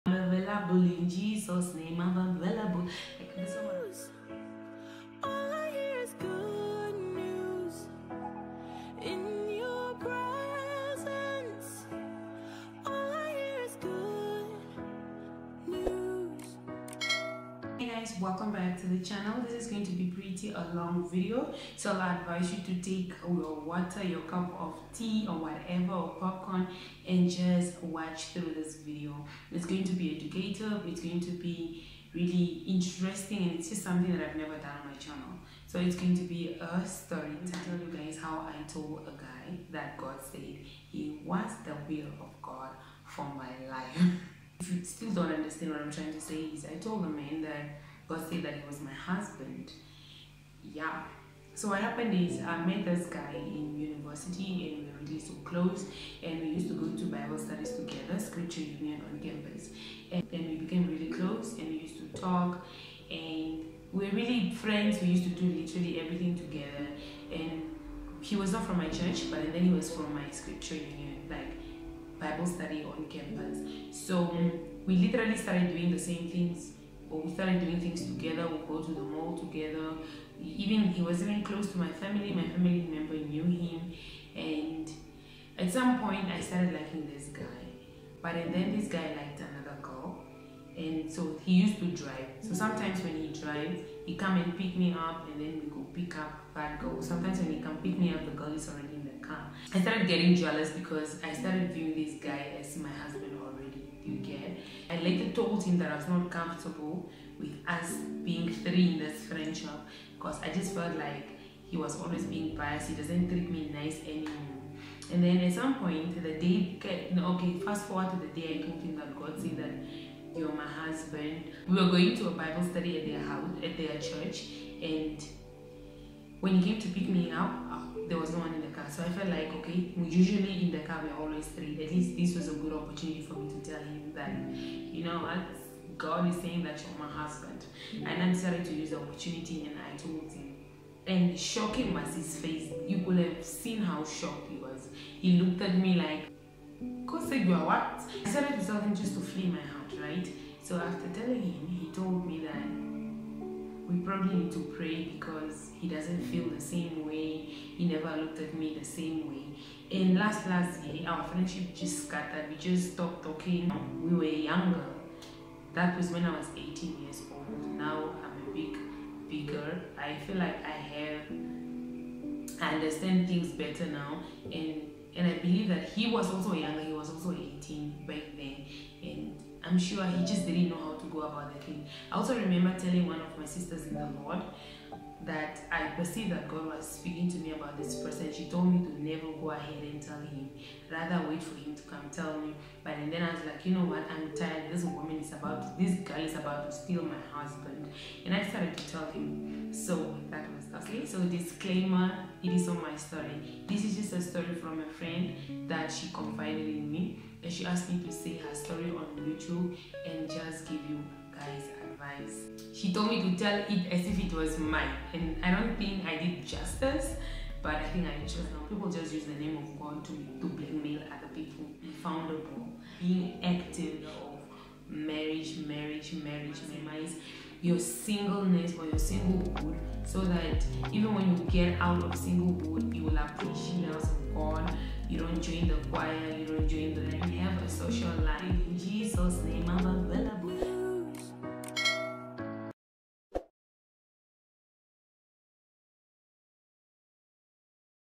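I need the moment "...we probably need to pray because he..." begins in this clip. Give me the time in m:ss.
2:33.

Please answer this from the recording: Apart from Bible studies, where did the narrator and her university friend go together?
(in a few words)
the mall.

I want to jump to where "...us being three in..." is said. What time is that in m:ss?
1:47.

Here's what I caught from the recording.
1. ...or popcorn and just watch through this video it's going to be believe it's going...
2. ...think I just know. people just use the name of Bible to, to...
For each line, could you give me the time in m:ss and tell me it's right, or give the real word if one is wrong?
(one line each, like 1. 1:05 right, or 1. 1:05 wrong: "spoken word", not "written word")
1. 0:25 wrong: "educative", not "believe"
2. 3:37 wrong: "God", not "Bible".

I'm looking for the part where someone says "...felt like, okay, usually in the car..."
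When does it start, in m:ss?
2:09.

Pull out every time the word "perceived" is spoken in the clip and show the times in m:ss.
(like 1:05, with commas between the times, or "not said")
3:05.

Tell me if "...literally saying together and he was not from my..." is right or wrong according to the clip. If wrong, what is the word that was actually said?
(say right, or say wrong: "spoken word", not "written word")
wrong: "everything", not "saying".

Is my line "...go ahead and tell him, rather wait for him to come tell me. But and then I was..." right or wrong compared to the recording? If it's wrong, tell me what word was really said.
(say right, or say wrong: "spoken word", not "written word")
right.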